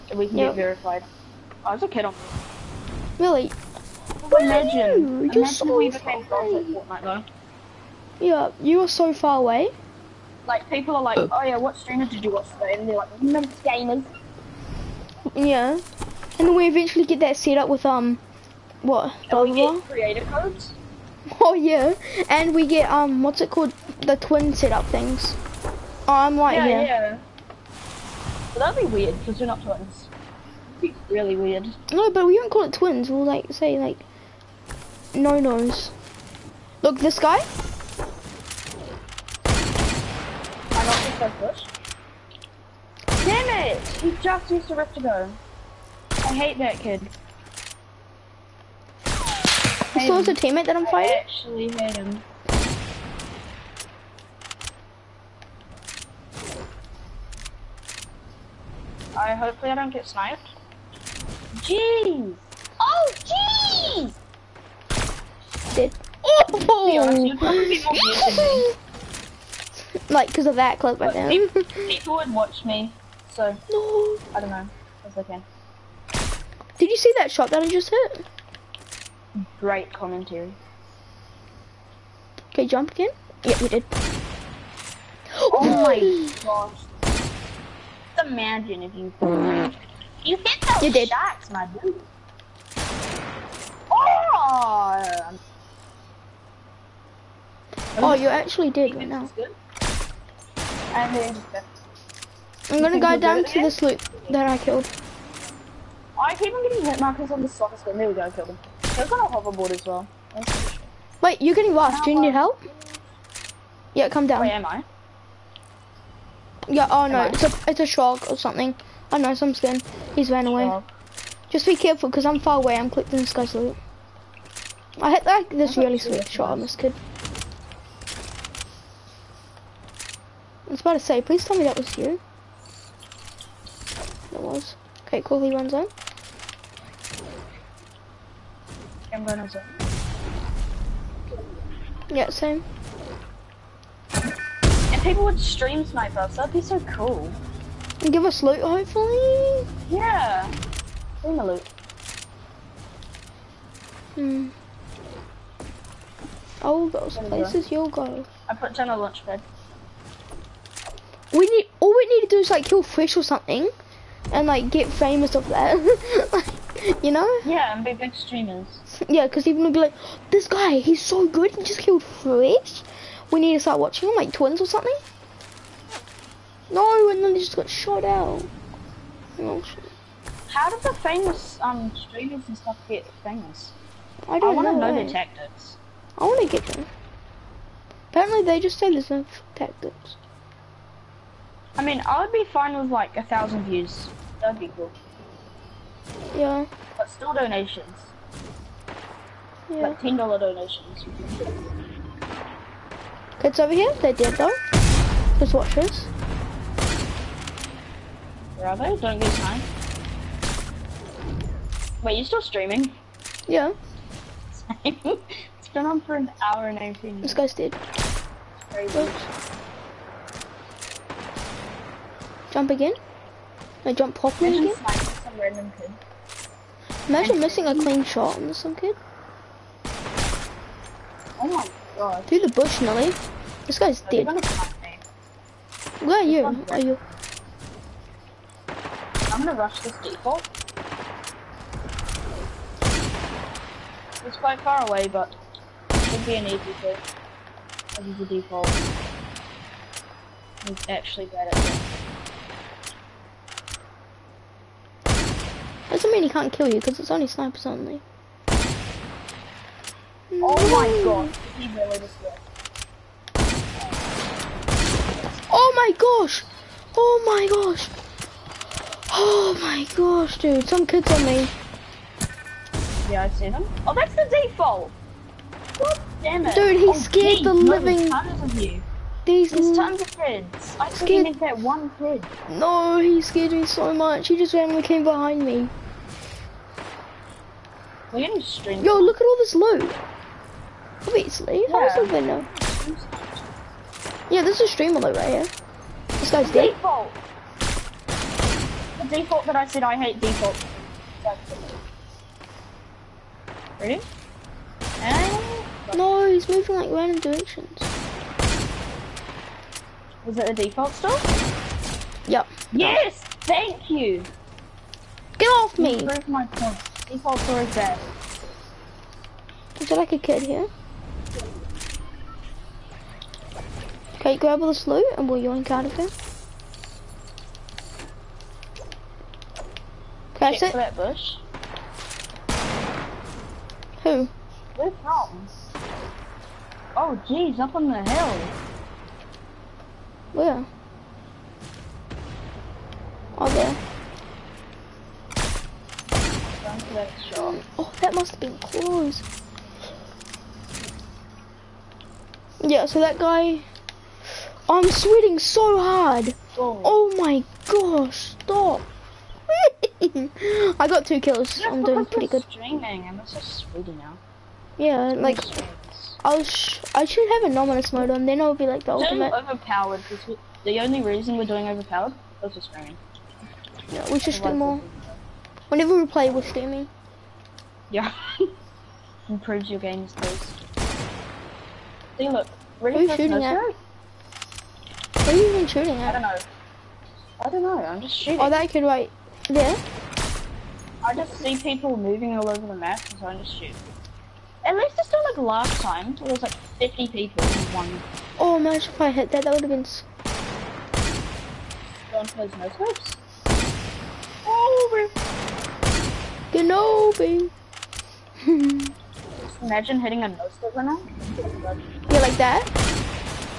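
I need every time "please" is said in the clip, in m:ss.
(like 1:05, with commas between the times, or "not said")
2:11.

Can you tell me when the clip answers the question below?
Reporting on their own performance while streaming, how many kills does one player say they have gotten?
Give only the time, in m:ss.
6:01.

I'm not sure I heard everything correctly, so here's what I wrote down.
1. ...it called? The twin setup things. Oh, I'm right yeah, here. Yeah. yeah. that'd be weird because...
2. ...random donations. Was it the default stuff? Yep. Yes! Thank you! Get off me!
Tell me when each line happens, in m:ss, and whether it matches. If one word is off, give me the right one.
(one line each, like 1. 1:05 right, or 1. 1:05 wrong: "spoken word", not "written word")
1. 0:23 right
2. 5:06 wrong: "directions", not "donations".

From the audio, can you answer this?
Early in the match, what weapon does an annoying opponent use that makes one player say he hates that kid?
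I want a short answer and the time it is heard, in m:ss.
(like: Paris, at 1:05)
Rift gun, at 0:44.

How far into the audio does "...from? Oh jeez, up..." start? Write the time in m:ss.
5:35.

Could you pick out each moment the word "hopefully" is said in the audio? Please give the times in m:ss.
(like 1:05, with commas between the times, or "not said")
0:59, 2:28.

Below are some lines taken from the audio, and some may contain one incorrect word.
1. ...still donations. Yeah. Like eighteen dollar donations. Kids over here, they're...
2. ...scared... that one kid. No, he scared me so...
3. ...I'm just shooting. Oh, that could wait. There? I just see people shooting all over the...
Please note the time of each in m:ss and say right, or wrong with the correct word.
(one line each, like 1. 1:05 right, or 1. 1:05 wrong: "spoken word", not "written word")
1. 3:17 wrong: "ten", not "eighteen"
2. 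4:40 right
3. 6:27 wrong: "moving", not "shooting".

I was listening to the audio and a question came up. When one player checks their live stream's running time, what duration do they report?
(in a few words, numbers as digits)
1 hour 19 minutes.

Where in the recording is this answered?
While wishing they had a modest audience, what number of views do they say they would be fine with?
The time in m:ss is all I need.
3:13.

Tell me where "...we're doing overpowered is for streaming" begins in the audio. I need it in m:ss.
6:11.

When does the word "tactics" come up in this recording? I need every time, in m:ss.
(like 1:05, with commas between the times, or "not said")
3:05, 3:09.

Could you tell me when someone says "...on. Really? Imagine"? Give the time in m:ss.
0:02.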